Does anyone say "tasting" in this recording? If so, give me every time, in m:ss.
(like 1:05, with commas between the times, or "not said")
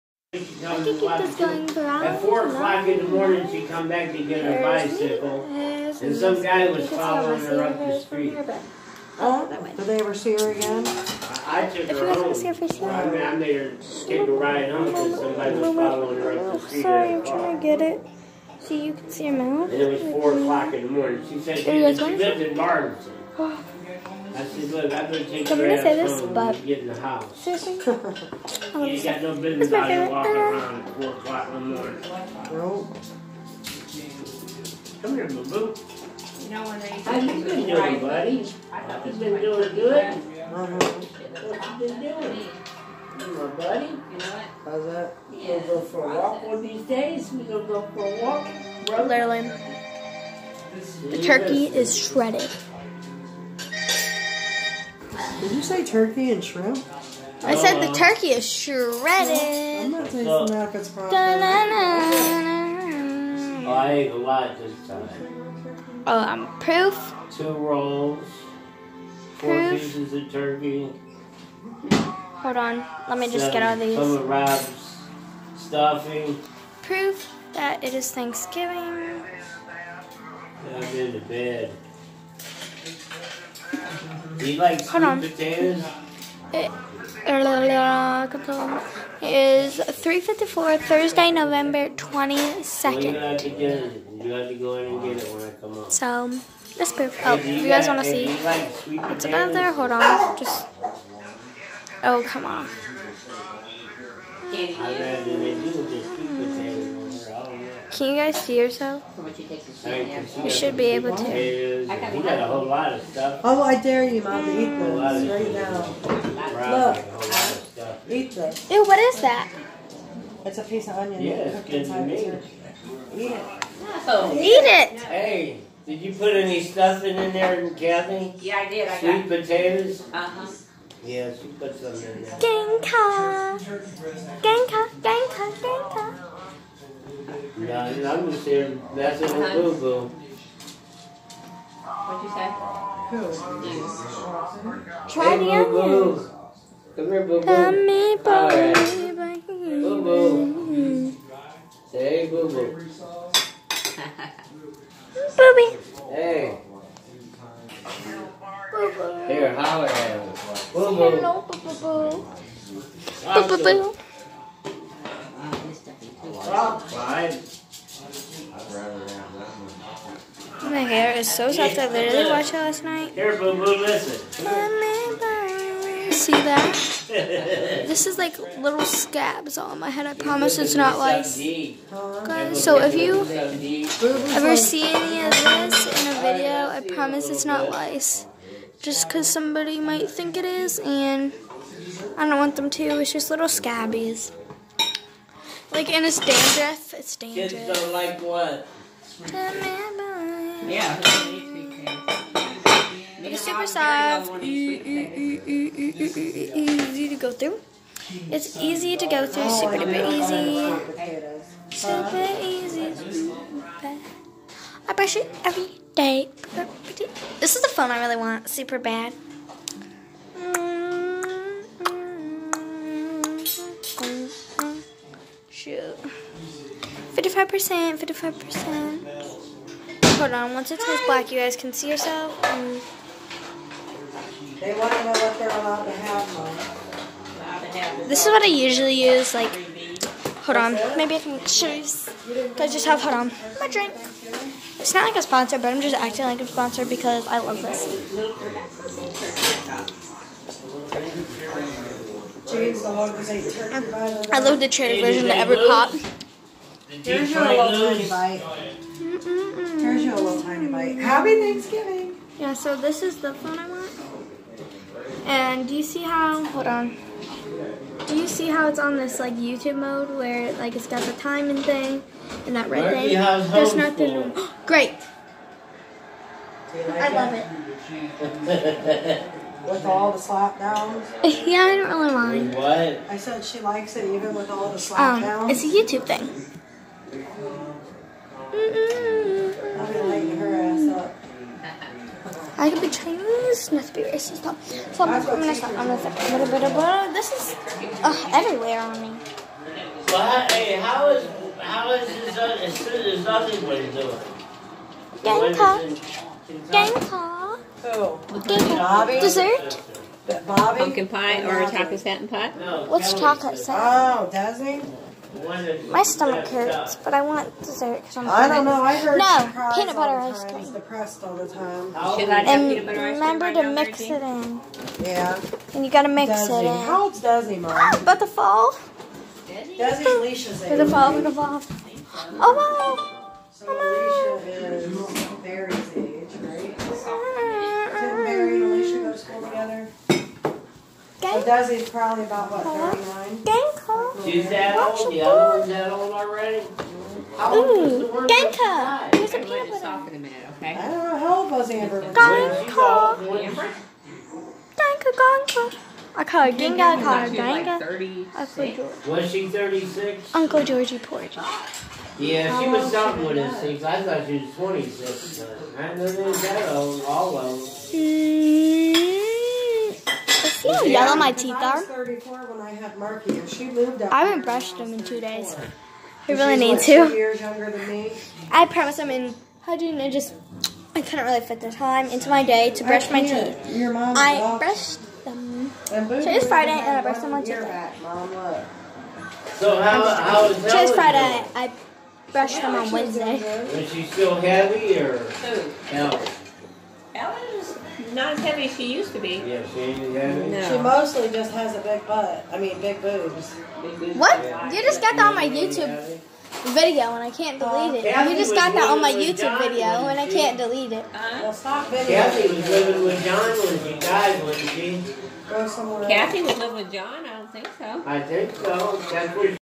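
1:00.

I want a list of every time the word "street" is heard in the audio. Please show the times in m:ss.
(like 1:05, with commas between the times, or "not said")
0:07, 0:16.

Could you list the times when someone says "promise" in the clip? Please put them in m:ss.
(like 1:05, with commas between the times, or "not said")
3:00, 3:06, 6:18.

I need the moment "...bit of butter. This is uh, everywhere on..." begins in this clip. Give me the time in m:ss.
4:56.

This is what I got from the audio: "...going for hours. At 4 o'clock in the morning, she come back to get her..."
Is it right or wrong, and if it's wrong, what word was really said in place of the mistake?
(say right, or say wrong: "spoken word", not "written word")
right.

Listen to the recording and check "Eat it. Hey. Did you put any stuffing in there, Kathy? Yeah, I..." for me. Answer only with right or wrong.
right.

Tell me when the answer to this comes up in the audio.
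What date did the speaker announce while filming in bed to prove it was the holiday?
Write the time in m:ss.
1:30.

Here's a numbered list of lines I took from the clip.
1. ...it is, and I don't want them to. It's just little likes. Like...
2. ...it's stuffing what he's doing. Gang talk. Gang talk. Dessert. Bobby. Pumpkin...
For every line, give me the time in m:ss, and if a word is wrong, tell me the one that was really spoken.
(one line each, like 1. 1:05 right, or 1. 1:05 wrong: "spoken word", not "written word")
1. 3:10 wrong: "scabbies", not "likes"
2. 5:02 wrong: "nothing", not "stuffing".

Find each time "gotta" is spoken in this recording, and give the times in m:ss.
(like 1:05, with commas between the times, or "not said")
5:25.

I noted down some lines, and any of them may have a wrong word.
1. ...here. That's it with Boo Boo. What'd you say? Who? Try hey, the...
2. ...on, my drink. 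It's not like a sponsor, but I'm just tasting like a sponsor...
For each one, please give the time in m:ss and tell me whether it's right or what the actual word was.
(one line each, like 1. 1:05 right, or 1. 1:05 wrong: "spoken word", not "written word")
1. 2:18 right
2. 4:03 wrong: "acting", not "tasting".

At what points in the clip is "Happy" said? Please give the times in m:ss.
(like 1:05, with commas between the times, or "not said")
4:20.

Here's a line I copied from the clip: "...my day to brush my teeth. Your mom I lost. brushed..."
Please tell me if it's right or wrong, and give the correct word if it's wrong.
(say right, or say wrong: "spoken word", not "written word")
right.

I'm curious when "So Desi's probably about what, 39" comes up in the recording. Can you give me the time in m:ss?
5:41.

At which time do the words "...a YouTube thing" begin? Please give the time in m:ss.
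4:45.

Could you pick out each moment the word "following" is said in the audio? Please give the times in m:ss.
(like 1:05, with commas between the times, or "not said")
0:06, 0:15.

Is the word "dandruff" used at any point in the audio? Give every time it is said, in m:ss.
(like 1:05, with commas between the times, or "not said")
3:16.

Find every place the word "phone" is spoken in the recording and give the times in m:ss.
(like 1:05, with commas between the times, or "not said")
3:37, 4:23.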